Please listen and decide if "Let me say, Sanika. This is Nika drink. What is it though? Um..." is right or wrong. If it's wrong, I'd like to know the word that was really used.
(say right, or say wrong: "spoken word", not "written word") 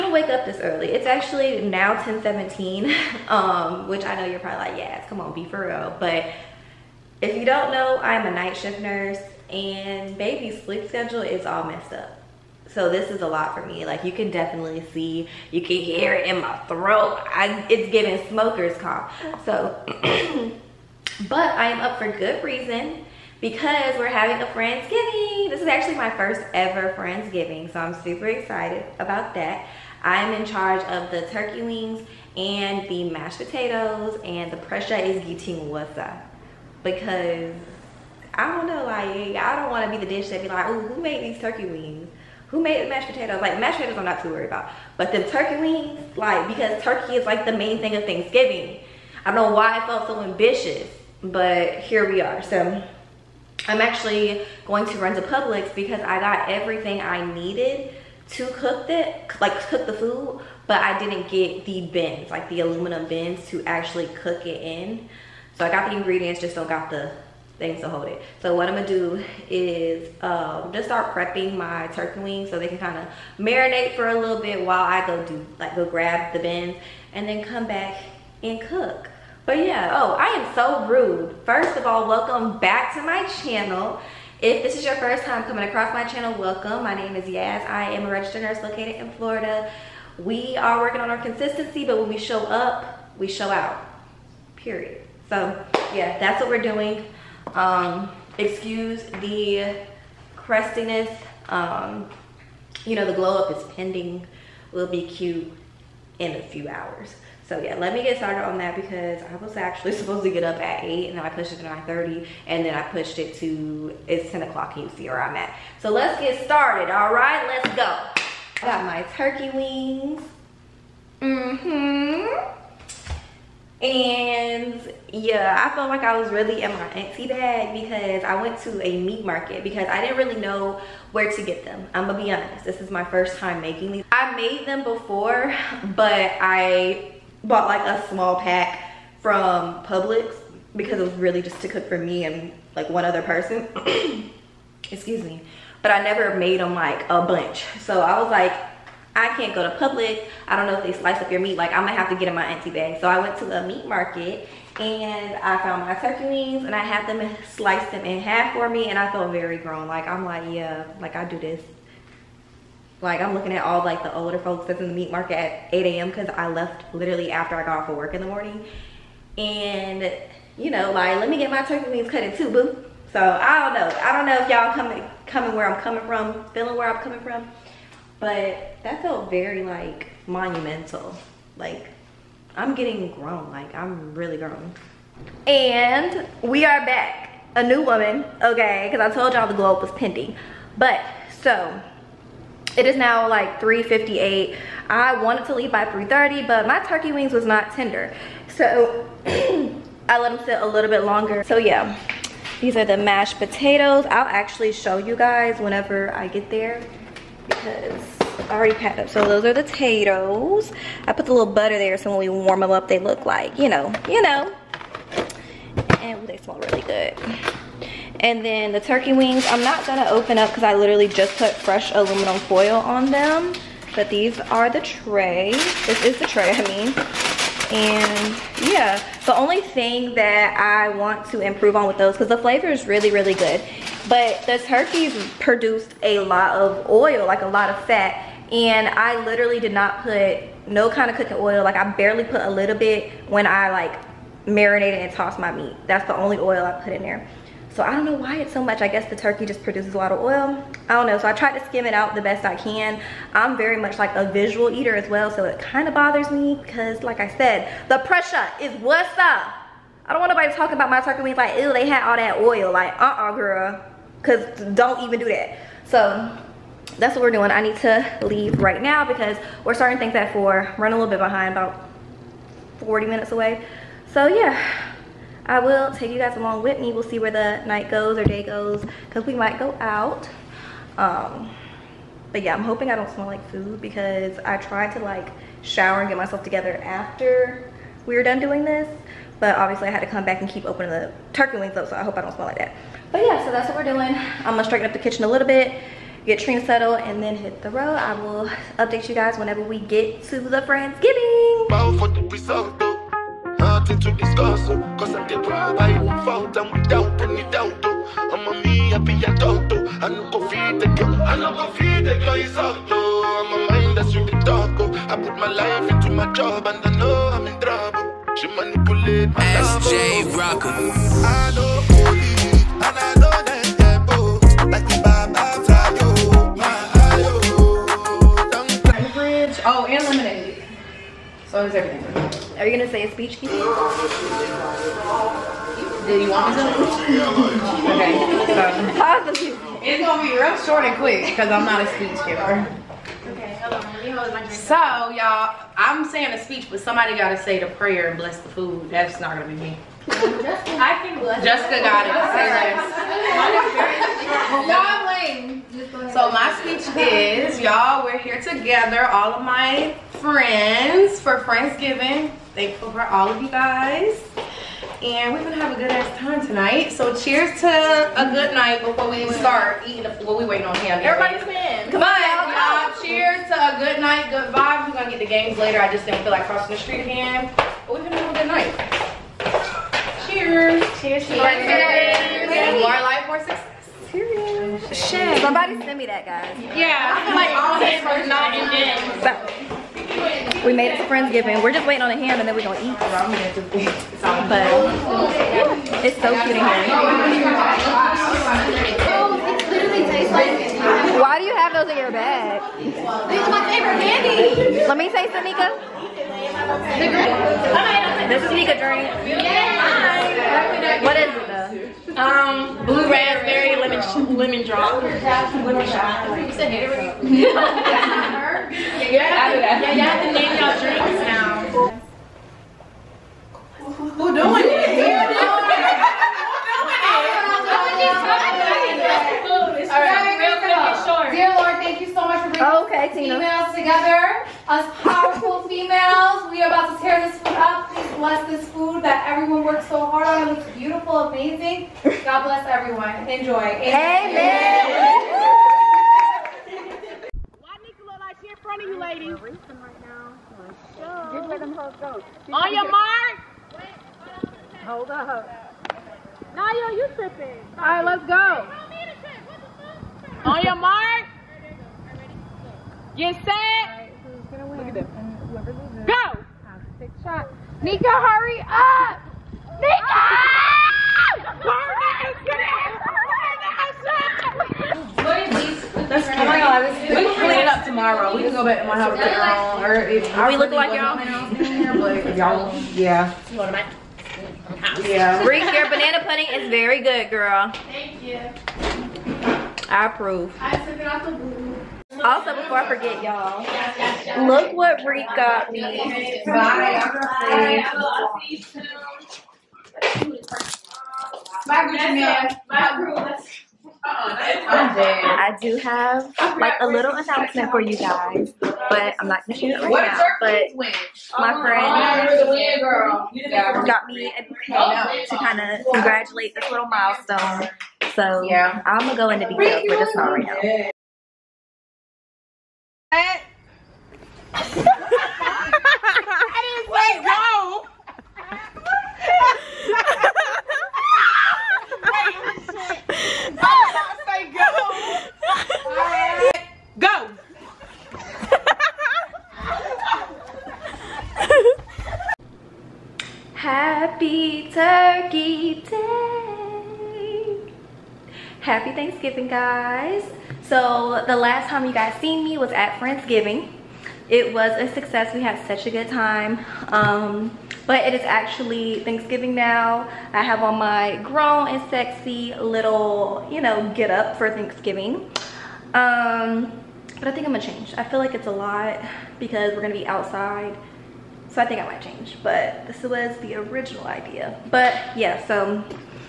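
right.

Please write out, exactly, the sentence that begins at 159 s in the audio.
Like I'm like, yeah, like I do this.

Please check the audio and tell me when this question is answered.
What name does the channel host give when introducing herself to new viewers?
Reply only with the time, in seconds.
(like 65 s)
87 s.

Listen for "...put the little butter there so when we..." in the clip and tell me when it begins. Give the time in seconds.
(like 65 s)
211 s.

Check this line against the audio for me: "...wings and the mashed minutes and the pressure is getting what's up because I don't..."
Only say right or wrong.
wrong.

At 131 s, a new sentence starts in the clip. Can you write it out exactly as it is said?
I'm gonna be honest, this is my first time making these.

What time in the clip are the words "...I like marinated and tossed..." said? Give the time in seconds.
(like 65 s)
243 s.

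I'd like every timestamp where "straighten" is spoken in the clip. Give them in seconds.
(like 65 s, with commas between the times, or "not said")
294 s.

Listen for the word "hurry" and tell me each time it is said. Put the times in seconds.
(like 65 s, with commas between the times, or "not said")
468 s.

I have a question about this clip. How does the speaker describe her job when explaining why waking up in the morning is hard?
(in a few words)
Night shift nurse.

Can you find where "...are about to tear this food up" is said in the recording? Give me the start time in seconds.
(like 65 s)
436 s.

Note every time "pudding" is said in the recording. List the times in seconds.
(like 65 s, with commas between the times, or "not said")
486 s.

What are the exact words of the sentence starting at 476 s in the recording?
Oh my god, we can clean it up tomorrow.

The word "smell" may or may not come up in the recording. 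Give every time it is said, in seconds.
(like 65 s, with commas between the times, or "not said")
216 s, 283 s, 292 s.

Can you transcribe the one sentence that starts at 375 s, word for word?
I just didn't feel like crossing the street again.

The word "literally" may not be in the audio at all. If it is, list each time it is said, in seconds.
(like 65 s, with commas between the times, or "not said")
166 s, 220 s, 239 s.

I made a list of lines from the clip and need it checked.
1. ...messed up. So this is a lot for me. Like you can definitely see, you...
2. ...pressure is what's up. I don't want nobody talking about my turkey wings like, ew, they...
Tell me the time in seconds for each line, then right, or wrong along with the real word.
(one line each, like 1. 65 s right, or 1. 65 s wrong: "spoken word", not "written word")
1. 11 s right
2. 257 s right.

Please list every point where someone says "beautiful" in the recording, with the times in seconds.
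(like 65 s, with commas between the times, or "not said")
430 s, 440 s.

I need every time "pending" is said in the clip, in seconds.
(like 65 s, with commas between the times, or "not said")
103 s, 189 s.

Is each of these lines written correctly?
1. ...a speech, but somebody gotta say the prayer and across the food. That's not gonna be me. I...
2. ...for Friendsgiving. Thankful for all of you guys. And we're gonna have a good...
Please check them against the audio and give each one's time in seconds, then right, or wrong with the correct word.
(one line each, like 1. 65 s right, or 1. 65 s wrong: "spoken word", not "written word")
1. 346 s wrong: "bless", not "across"
2. 361 s right.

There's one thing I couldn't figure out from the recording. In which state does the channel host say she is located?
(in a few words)
Florida.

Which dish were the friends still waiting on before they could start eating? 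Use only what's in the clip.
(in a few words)
A ham.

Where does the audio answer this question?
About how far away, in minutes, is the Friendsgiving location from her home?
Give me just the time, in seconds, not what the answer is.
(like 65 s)
272 s.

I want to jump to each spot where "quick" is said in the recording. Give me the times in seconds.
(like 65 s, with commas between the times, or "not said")
340 s.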